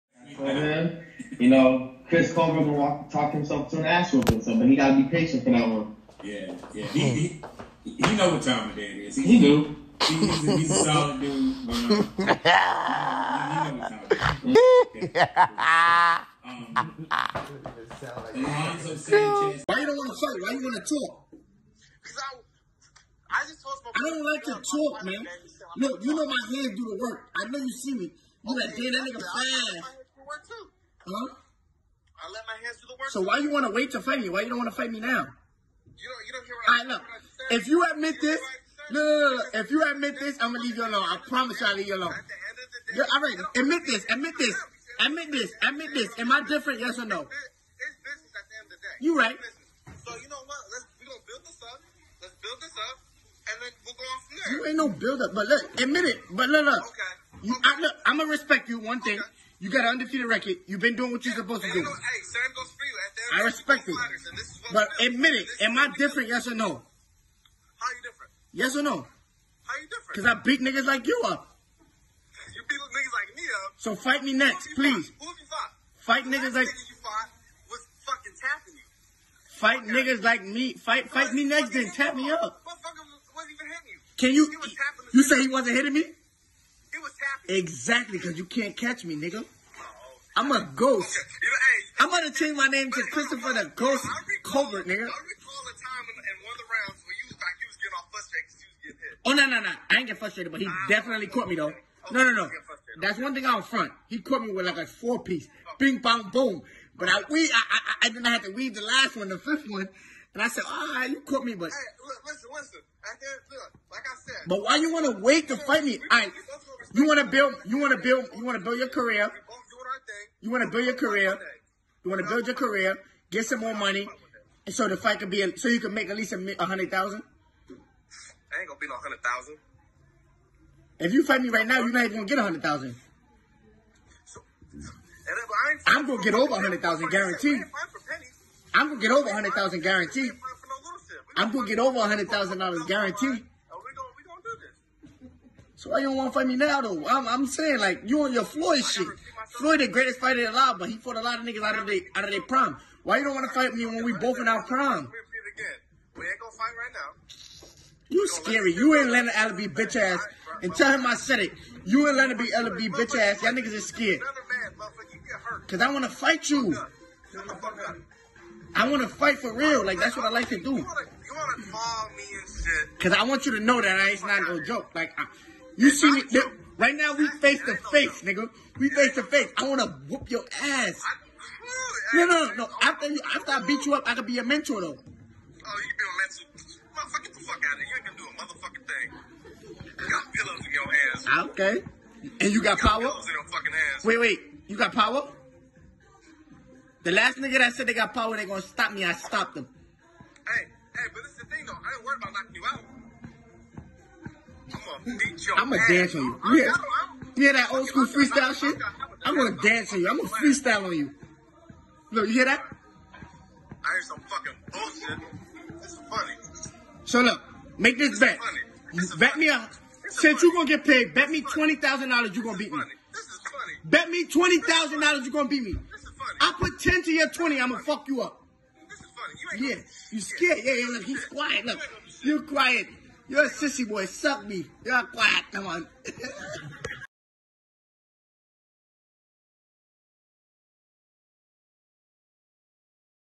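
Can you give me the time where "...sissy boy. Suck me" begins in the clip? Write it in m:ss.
3:53.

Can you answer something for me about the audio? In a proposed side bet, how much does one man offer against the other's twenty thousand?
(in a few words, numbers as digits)
10.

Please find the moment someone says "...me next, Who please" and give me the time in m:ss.
1:14.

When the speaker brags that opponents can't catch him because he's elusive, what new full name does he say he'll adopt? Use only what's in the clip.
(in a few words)
Christopher the Ghost Covert.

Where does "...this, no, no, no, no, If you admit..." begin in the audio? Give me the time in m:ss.
0:38.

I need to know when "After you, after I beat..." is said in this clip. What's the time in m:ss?
3:02.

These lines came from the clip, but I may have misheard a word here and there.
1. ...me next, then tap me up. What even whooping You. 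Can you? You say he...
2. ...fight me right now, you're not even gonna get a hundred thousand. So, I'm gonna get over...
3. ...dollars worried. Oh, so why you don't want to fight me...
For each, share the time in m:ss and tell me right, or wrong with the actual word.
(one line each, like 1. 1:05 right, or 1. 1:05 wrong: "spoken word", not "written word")
1. 1:21 wrong: "hitting", not "whooping"
2. 2:11 right
3. 2:22 wrong: "guaranteed", not "worried".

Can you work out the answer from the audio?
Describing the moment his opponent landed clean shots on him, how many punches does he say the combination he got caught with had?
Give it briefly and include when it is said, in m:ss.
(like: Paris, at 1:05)
4 piece, at 1:44.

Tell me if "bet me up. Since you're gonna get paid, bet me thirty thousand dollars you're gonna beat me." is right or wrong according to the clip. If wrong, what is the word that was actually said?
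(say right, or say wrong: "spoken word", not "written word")
wrong: "twenty", not "thirty".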